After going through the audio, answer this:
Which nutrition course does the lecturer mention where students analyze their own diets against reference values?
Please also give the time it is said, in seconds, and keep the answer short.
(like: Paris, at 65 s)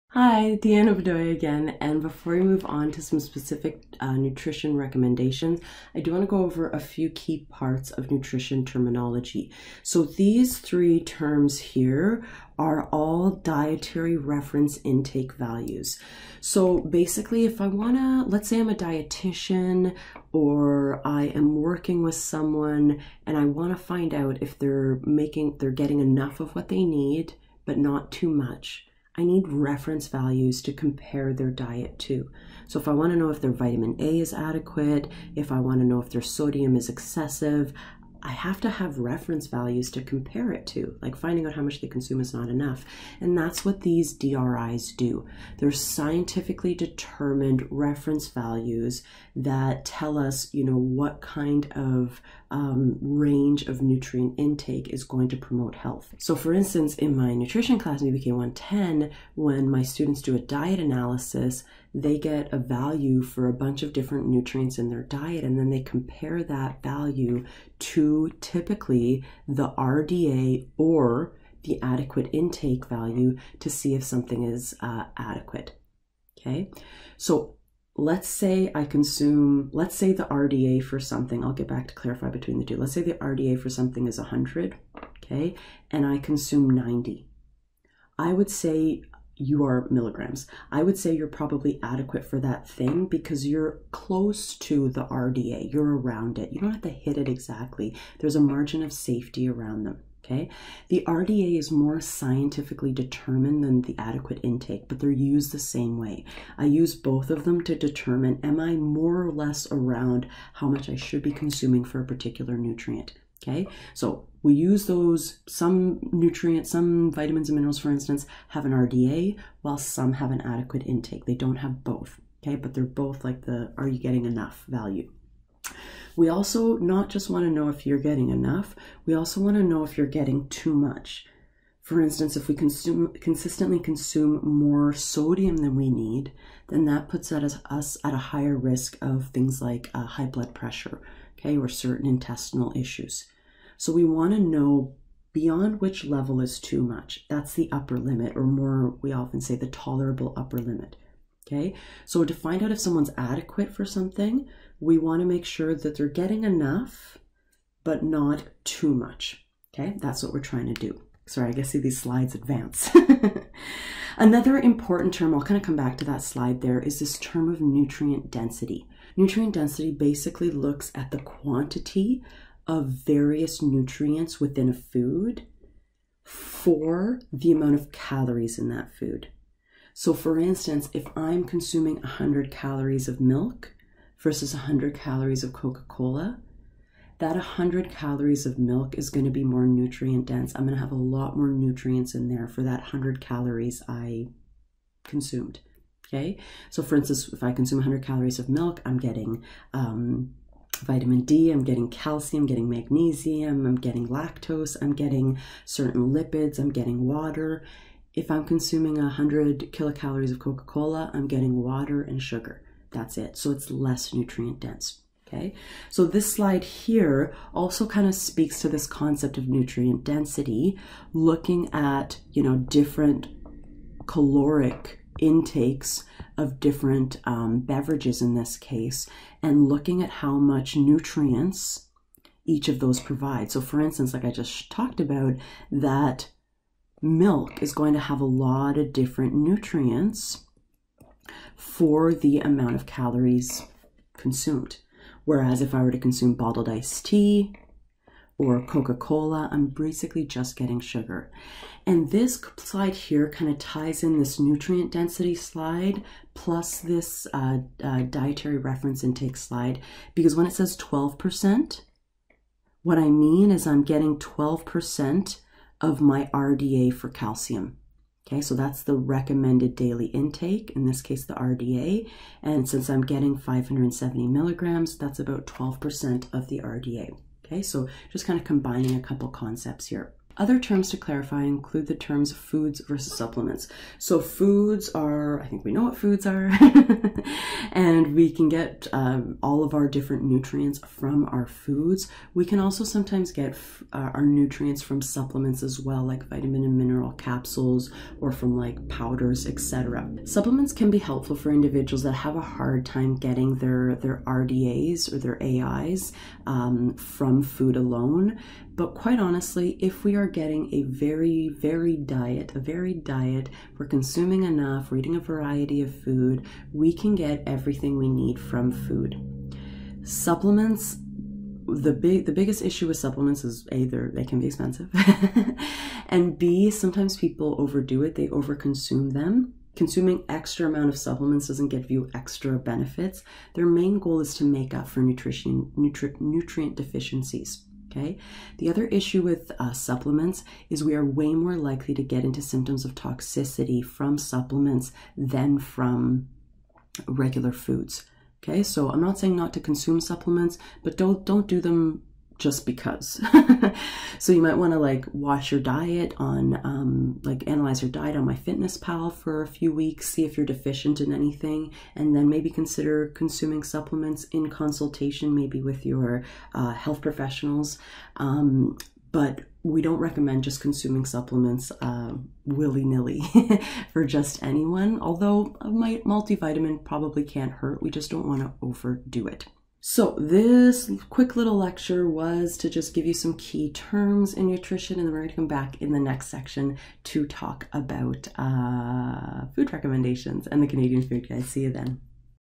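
BPK 110, at 58 s.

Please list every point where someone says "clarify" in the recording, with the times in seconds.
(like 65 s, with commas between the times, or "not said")
81 s, 280 s.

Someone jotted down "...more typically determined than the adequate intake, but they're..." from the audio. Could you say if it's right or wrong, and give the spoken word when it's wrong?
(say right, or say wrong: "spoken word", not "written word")
wrong: "scientifically", not "typically".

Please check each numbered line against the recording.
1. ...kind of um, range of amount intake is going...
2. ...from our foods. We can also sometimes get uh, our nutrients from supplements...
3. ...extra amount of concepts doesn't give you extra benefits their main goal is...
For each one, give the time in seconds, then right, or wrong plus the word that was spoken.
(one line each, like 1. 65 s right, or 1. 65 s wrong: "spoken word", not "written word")
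1. 51 s wrong: "nutrient", not "amount"
2. 290 s right
3. 330 s wrong: "supplements", not "concepts".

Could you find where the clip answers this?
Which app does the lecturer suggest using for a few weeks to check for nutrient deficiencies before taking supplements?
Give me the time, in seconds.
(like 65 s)
358 s.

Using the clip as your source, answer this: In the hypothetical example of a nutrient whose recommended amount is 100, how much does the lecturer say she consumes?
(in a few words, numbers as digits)
90.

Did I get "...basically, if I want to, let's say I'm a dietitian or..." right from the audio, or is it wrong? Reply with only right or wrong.
right.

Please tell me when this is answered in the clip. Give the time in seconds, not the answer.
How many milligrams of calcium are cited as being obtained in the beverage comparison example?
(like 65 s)
273 s.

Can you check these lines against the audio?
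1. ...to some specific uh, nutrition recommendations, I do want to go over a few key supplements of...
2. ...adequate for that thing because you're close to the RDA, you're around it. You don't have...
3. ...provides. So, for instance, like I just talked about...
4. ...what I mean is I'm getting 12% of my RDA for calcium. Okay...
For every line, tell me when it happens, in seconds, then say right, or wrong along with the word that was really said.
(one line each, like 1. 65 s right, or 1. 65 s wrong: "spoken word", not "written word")
1. 2 s wrong: "parts", not "supplements"
2. 91 s right
3. 232 s right
4. 262 s right.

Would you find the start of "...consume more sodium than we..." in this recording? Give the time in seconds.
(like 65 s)
133 s.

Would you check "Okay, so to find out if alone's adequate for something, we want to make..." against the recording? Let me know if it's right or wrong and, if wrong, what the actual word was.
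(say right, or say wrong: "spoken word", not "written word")
wrong: "someone", not "alone".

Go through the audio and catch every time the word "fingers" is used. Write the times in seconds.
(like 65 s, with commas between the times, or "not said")
not said.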